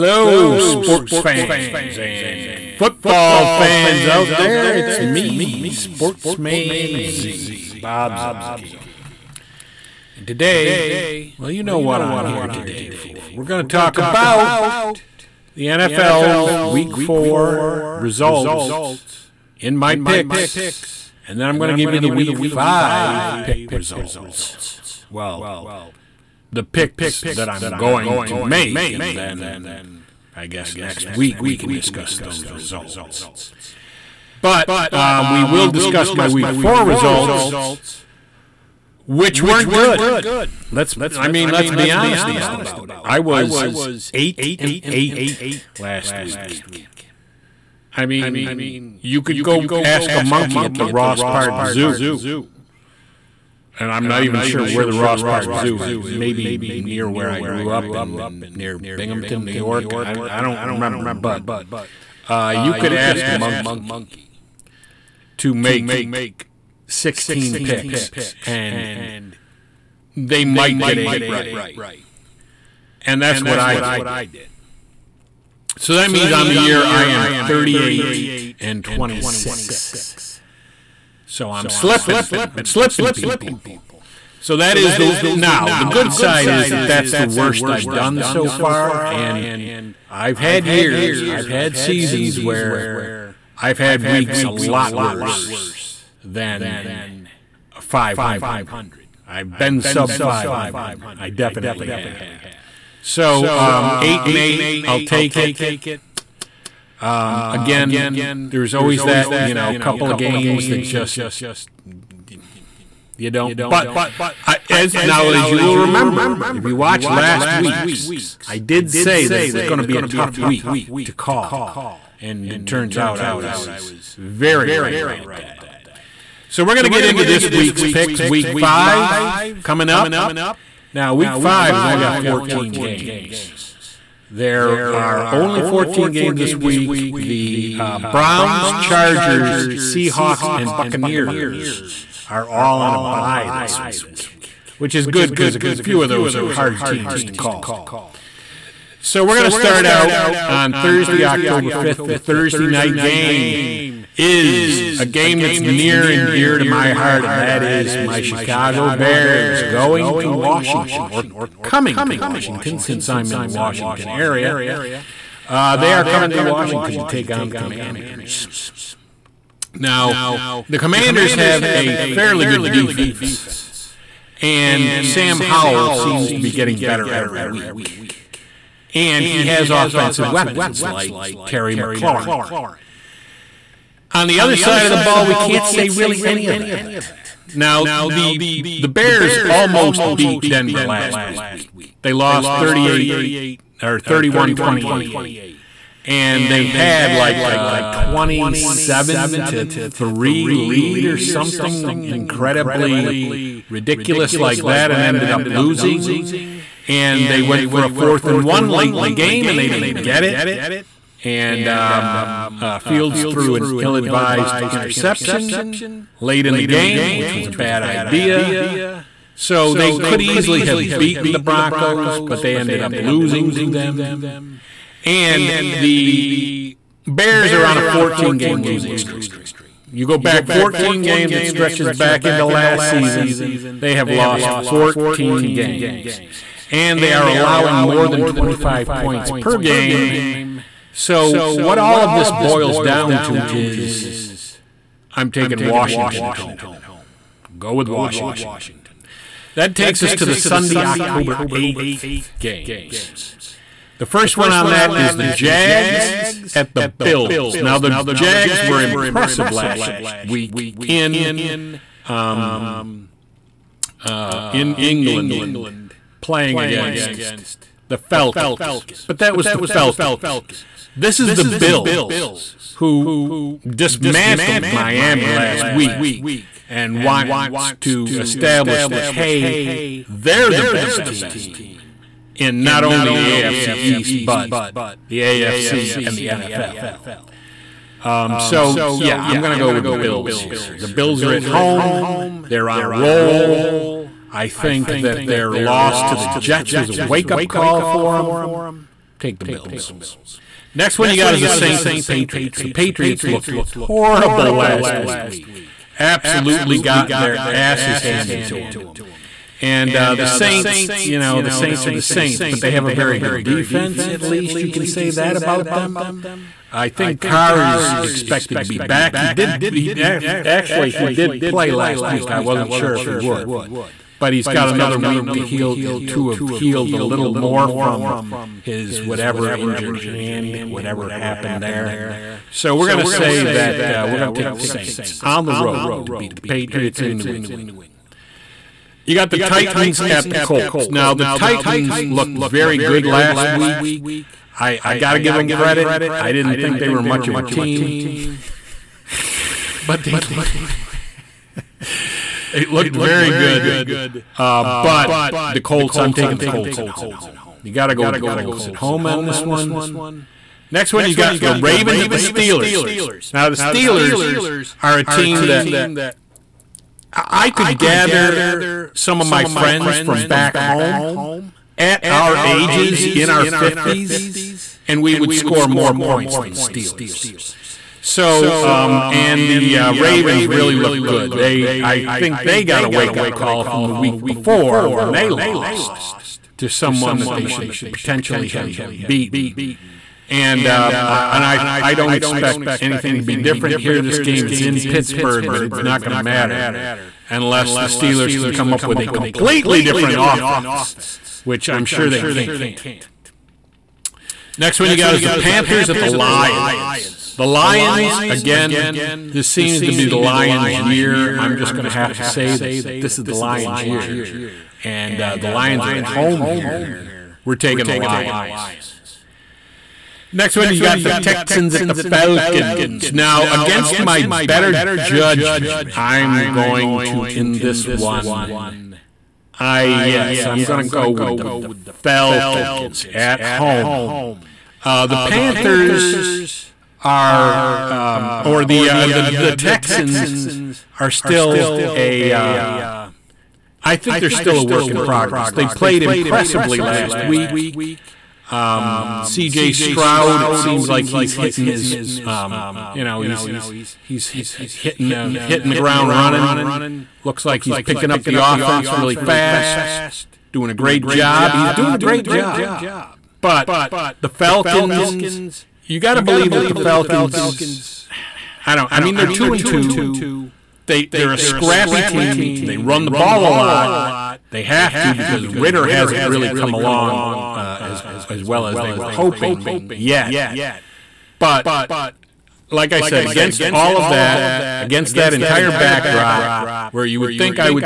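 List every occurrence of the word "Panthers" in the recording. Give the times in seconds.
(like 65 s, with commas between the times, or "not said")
405 s, 435 s.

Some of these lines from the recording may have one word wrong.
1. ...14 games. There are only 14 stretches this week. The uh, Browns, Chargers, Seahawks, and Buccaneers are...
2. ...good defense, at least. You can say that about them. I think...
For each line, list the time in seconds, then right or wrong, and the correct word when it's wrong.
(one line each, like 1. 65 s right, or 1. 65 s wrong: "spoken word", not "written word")
1. 132 s wrong: "games", not "stretches"
2. 313 s right.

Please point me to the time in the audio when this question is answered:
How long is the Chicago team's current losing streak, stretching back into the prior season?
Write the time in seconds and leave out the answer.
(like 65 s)
227 s.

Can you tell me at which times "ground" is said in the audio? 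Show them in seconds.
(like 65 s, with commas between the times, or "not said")
455 s.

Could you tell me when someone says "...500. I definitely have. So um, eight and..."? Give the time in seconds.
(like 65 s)
100 s.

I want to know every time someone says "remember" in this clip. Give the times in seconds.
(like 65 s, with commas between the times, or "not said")
60 s, 115 s.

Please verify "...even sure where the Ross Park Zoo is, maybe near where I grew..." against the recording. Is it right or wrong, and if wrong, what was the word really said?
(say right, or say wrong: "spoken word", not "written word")
right.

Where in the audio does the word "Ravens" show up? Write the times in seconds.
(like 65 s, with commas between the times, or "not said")
361 s, 379 s.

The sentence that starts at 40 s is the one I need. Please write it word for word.
Let's, I mean, let's be honest about it.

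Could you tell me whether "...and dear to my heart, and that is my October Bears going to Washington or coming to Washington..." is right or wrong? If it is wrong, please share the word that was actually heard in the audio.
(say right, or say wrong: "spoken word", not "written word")
wrong: "Chicago", not "October".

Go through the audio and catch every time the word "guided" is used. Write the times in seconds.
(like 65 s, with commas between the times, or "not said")
not said.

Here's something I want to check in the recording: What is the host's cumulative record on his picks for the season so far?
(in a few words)
38 and 26.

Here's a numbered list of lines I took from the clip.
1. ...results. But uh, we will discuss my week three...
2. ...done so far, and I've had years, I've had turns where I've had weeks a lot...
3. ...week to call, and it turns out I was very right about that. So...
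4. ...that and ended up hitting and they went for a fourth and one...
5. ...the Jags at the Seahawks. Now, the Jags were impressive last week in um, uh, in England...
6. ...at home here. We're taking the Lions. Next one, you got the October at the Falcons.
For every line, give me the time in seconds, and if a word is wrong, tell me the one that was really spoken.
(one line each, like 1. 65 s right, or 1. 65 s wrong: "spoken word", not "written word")
1. 32 s wrong: "four", not "three"
2. 87 s wrong: "seasons", not "turns"
3. 120 s right
4. 204 s wrong: "losing", not "hitting"
5. 255 s wrong: "Bills", not "Seahawks"
6. 415 s wrong: "Texans", not "October".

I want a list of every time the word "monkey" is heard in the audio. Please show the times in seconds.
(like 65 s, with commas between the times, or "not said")
50 s, 63 s.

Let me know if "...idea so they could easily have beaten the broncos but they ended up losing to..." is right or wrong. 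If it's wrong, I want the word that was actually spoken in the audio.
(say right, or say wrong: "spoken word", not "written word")
right.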